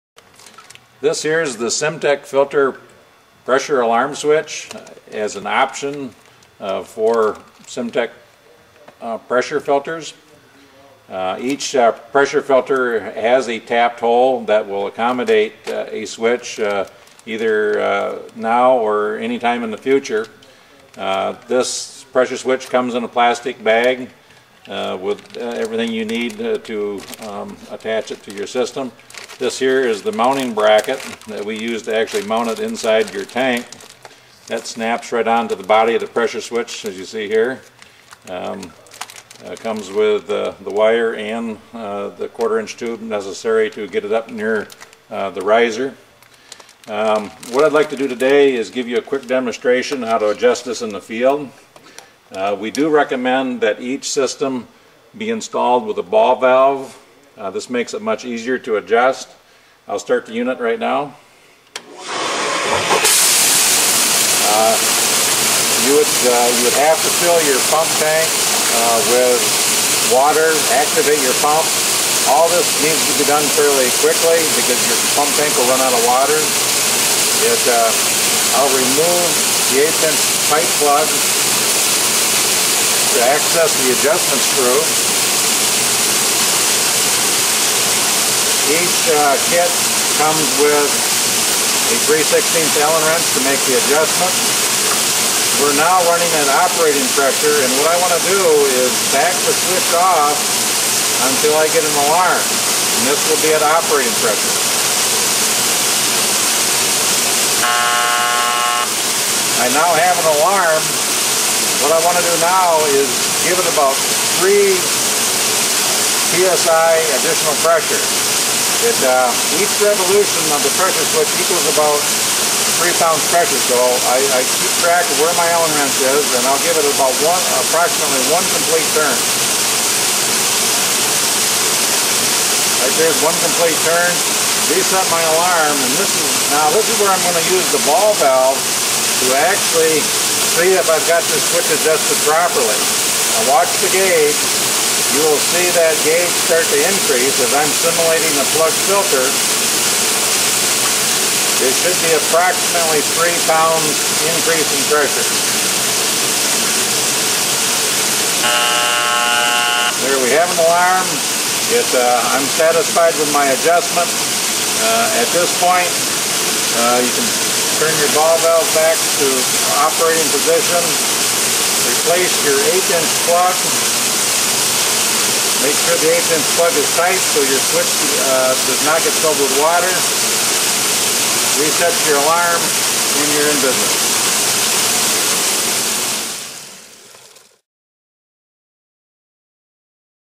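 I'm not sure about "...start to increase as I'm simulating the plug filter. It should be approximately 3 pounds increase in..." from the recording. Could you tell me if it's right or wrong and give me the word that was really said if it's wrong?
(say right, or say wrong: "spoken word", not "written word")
right.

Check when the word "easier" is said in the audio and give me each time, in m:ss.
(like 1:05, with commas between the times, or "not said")
0:58.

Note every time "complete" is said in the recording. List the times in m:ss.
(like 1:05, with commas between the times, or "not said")
2:08, 2:13.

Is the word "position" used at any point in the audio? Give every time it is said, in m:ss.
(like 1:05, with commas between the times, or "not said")
2:50.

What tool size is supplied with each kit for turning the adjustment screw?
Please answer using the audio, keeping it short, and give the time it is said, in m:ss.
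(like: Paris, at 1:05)
3 Allen wrench, at 1:32.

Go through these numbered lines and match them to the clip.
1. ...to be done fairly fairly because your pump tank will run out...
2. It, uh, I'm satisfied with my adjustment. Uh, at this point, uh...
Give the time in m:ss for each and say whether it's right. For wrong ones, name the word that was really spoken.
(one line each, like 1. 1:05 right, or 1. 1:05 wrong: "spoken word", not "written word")
1. 1:13 wrong: "quickly", not "fairly"
2. 2:41 right.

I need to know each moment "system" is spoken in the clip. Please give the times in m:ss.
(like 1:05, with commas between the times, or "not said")
0:28, 0:54.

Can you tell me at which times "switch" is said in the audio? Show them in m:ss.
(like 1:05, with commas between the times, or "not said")
0:04, 0:16, 0:22, 0:36, 1:39, 2:01, 2:21, 2:57.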